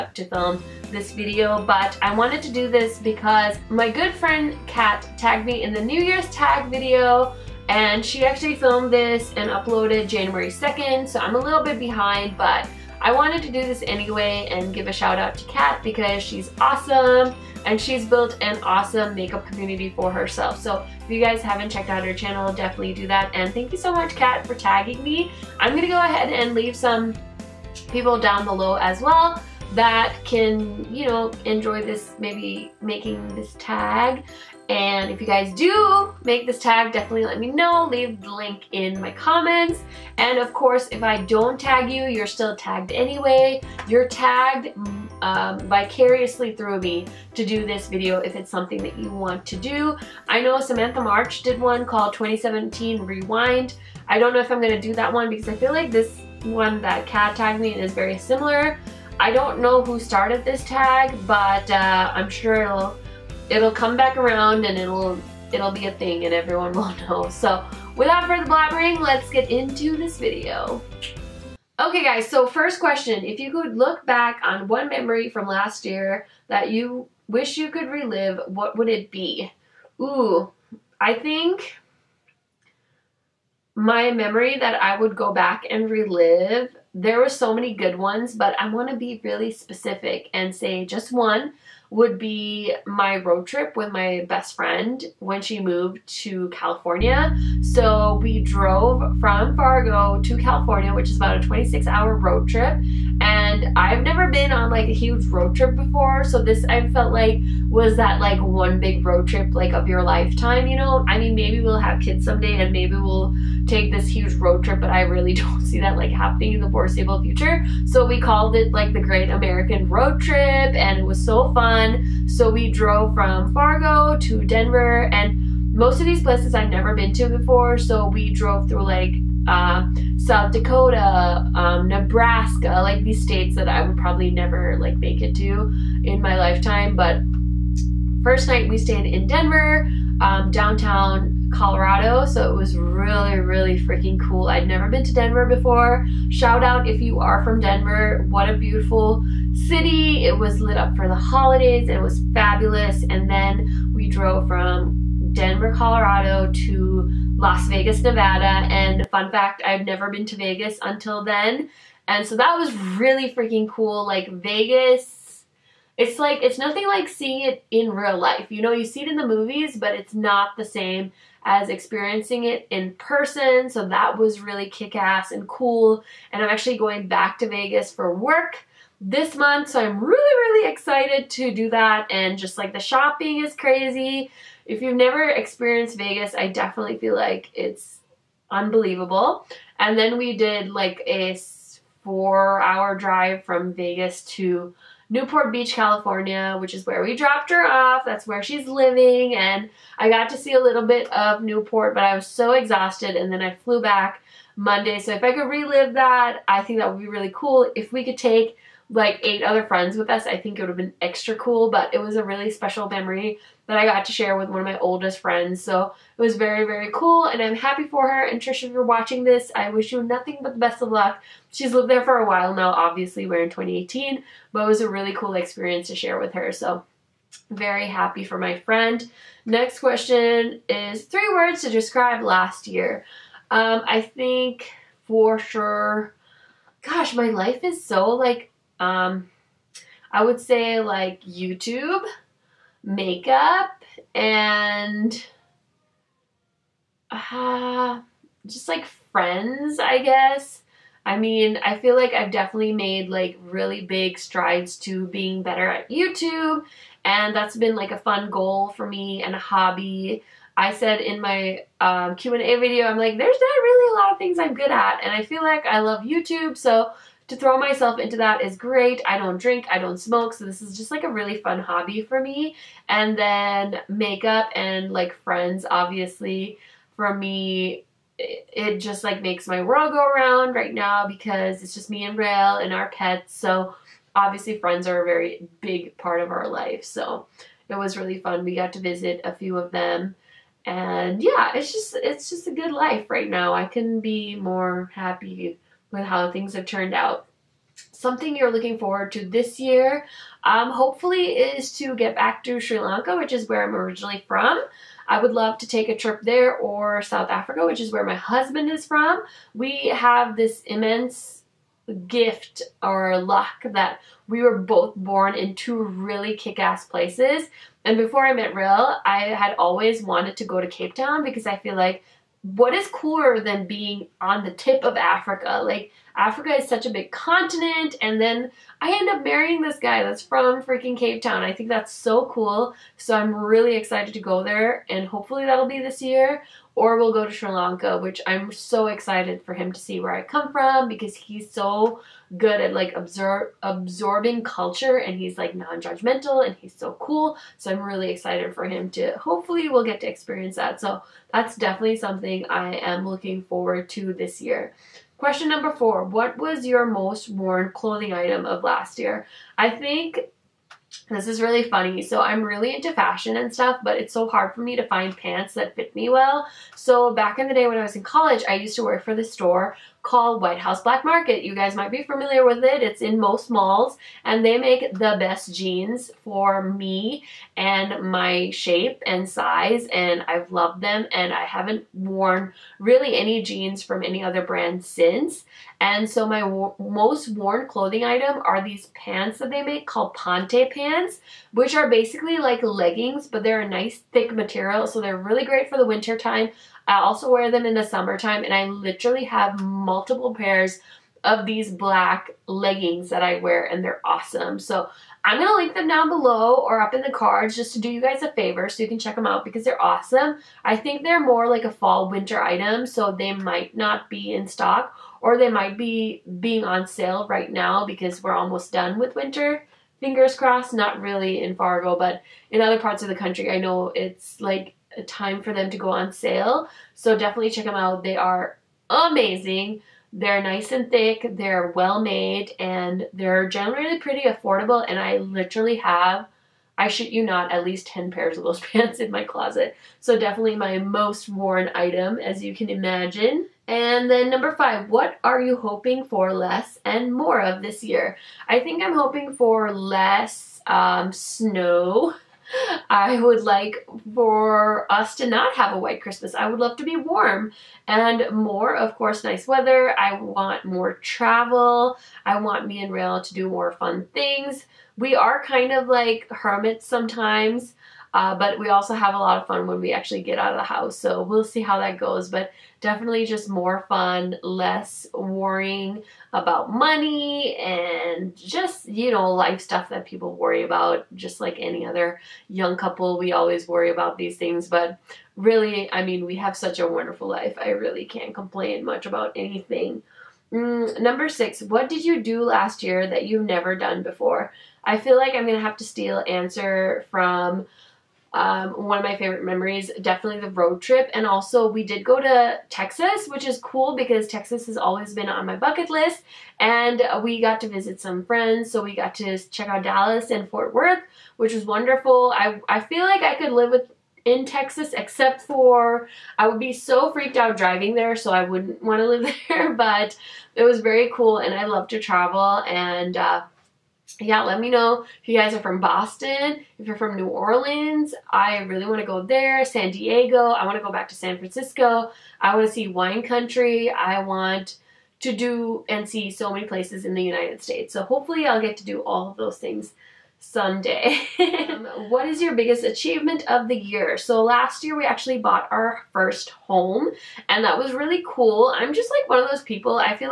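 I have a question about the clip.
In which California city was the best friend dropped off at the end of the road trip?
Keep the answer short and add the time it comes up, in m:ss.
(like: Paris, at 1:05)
Newport Beach, at 3:15.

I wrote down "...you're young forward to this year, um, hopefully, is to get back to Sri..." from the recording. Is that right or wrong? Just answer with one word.
wrong.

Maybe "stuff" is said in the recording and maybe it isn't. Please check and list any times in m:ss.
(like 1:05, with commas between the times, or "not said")
6:03, 7:59.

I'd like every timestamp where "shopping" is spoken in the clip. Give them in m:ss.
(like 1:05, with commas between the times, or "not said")
3:02.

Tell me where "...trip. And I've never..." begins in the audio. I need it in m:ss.
1:42.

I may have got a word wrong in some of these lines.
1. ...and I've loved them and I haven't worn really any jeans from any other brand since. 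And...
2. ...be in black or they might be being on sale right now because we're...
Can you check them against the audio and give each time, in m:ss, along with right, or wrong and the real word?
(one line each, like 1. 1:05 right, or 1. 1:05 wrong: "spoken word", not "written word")
1. 6:19 right
2. 6:54 wrong: "stock", not "black".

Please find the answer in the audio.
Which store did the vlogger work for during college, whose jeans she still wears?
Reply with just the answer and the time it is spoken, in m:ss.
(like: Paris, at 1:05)
White House Black Market, at 6:10.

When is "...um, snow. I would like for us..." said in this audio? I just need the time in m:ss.
7:30.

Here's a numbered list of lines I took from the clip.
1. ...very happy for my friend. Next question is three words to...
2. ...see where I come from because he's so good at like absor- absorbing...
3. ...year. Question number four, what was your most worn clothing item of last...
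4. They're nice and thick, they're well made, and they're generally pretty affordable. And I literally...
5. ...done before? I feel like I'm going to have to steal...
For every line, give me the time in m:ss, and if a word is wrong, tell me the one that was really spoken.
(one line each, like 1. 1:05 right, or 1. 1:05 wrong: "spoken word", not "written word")
1. 3:47 right
2. 5:39 right
3. 5:54 right
4. 7:10 right
5. 8:13 right.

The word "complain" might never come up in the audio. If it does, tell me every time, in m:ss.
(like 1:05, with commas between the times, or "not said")
8:08.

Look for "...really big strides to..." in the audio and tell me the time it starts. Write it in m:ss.
4:13.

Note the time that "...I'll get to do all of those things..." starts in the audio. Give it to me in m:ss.
8:58.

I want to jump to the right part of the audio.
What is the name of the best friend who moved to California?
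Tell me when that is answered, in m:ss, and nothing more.
3:38.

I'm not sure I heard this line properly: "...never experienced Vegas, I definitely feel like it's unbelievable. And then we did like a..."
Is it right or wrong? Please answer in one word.
right.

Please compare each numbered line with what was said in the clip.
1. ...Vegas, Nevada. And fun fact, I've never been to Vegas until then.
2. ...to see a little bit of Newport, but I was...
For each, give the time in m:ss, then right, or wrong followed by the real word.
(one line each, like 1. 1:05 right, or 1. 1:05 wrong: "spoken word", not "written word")
1. 2:37 right
2. 3:20 right.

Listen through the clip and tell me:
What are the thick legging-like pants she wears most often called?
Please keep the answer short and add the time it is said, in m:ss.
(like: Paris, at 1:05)
Ponte pants, at 6:30.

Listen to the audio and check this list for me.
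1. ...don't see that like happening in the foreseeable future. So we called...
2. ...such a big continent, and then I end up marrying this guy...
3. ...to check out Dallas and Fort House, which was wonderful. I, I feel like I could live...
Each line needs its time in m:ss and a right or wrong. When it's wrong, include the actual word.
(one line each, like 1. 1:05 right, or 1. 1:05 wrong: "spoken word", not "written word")
1. 1:55 right
2. 5:26 right
3. 8:29 wrong: "Worth", not "House".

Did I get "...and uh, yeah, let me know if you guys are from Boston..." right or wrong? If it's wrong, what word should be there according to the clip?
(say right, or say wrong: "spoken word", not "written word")
right.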